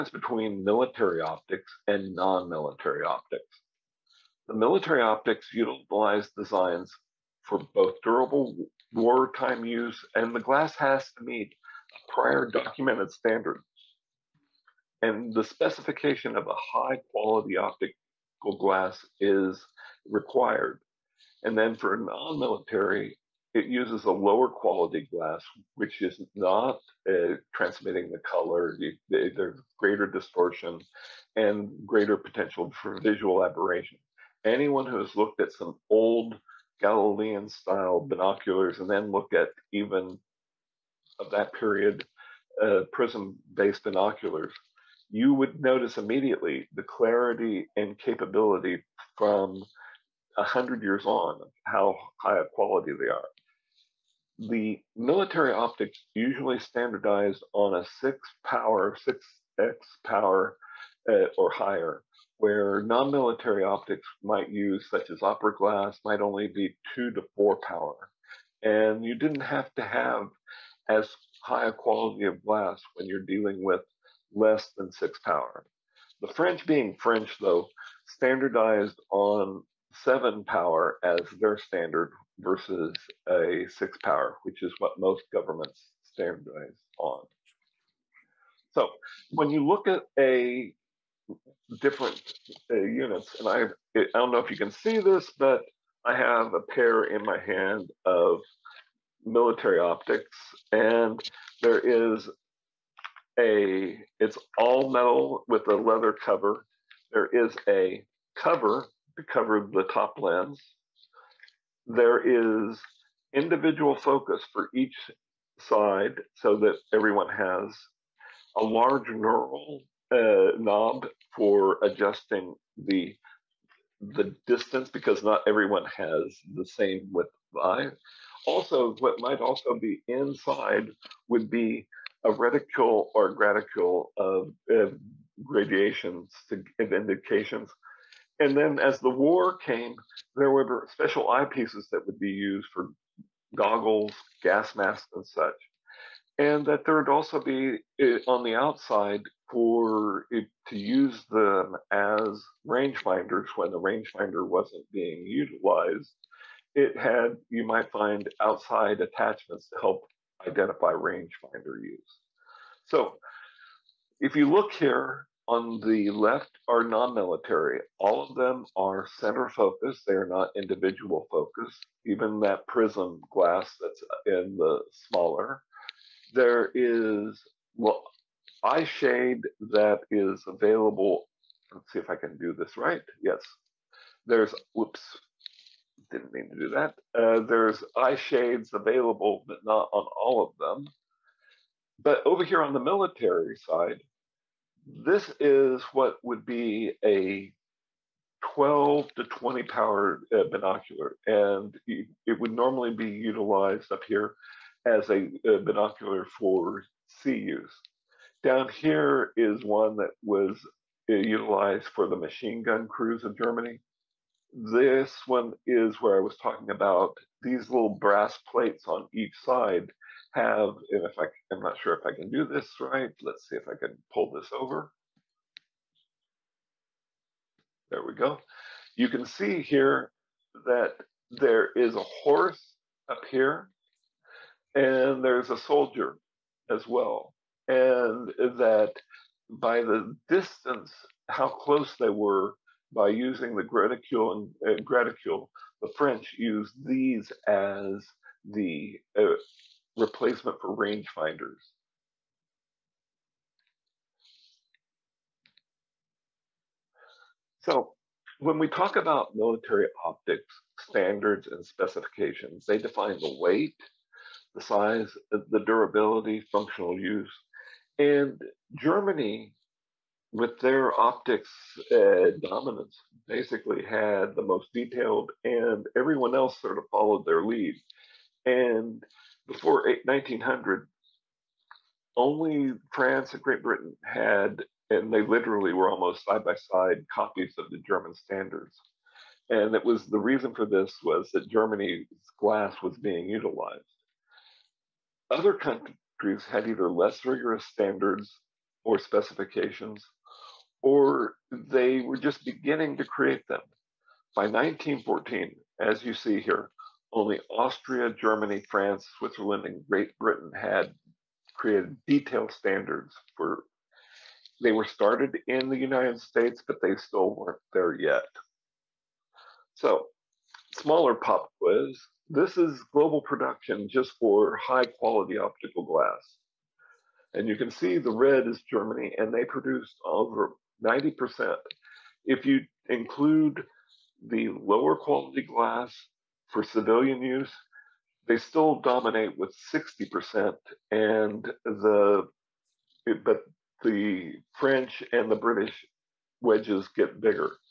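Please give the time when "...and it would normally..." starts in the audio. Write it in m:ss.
3:21.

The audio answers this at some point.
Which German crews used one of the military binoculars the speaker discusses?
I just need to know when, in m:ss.
3:32.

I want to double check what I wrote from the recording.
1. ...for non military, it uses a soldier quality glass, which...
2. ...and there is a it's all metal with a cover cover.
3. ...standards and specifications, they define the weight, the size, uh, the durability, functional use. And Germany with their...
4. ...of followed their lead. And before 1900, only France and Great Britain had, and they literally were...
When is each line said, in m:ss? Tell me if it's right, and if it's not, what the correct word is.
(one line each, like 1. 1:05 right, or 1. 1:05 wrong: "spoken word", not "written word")
1. 0:21 wrong: "lower", not "soldier"
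2. 1:40 wrong: "leather", not "cover"
3. 4:20 right
4. 4:36 right.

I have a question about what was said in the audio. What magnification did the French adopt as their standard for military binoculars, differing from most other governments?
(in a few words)
7 power.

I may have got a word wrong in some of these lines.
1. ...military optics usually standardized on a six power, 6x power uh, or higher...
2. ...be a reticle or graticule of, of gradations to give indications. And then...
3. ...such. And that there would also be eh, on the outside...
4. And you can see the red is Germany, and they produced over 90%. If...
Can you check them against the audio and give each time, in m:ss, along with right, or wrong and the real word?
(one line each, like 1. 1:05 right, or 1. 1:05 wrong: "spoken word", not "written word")
1. 0:54 right
2. 2:11 right
3. 2:25 right
4. 5:27 right.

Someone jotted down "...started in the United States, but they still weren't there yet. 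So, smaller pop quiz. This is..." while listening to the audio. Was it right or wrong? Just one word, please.
right.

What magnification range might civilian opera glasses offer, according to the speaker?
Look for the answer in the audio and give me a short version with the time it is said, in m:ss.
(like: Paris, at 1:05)
2 to 4 power, at 1:06.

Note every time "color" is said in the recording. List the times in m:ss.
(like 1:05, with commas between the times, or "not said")
0:28.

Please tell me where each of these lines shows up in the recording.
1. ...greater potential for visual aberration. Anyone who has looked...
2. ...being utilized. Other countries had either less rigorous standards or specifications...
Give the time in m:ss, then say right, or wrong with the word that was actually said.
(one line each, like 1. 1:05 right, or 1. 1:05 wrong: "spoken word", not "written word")
1. 0:31 right
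2. 4:52 right.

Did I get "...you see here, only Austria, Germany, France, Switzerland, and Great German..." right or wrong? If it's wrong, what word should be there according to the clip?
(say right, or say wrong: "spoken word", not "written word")
wrong: "Britain", not "German".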